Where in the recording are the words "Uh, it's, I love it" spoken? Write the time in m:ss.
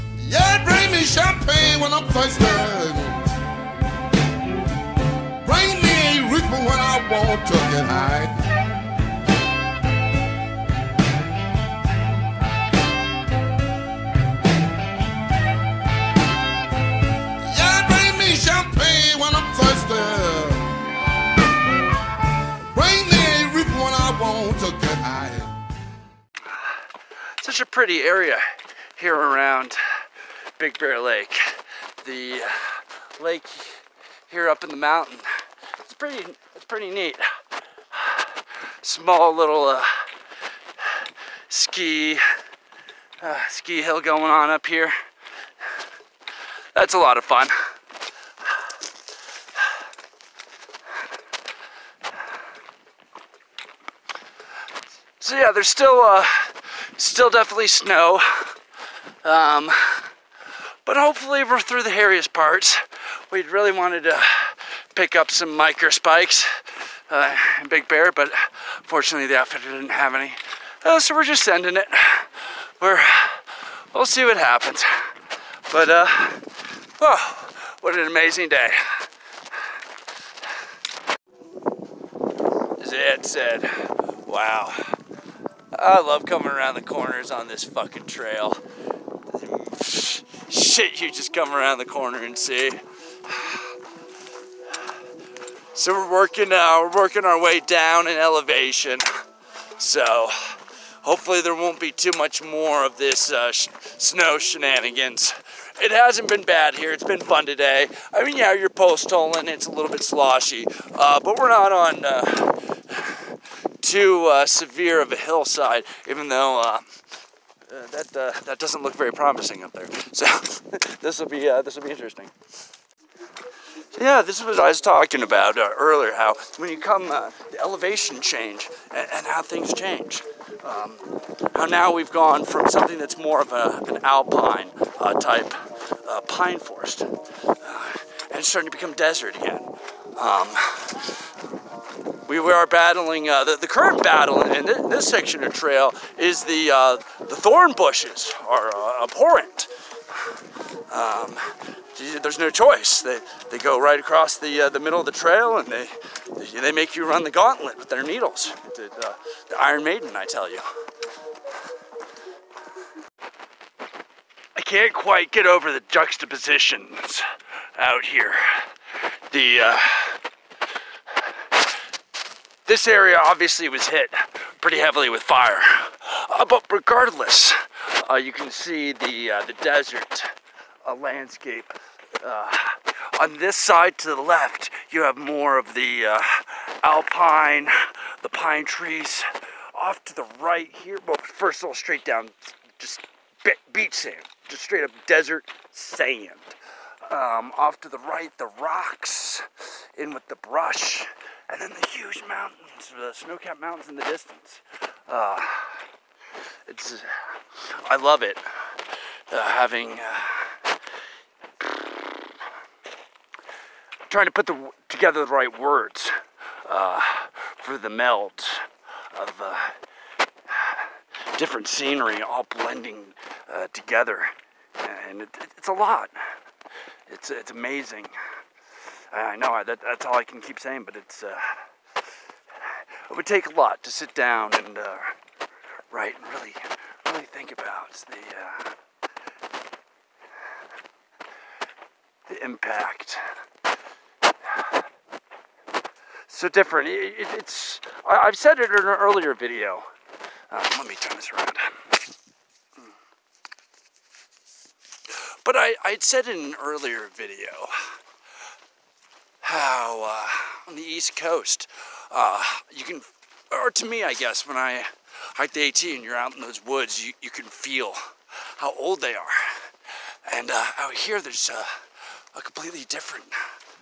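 3:25.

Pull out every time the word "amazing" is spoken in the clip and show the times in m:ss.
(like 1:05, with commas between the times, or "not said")
1:18, 3:47.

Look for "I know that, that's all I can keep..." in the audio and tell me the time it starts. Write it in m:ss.
3:49.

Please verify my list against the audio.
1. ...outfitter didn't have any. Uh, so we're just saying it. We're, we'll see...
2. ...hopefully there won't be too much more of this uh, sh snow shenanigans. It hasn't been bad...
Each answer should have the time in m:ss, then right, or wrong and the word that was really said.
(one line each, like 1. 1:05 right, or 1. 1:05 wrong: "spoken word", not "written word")
1. 1:09 wrong: "sending", not "saying"
2. 1:41 right.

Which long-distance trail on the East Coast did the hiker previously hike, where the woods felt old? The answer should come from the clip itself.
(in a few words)
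AT.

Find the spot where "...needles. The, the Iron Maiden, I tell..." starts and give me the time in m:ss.
2:38.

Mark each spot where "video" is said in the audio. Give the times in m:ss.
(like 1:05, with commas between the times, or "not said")
4:09, 4:17.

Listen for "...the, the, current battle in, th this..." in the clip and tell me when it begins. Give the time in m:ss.
2:23.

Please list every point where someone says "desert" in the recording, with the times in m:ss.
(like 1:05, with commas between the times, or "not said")
2:18, 2:59, 3:15.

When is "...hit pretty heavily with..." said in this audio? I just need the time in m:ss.
2:53.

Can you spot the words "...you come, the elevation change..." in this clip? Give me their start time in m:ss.
2:06.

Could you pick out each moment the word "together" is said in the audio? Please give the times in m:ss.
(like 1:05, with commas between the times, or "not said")
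3:34, 3:43.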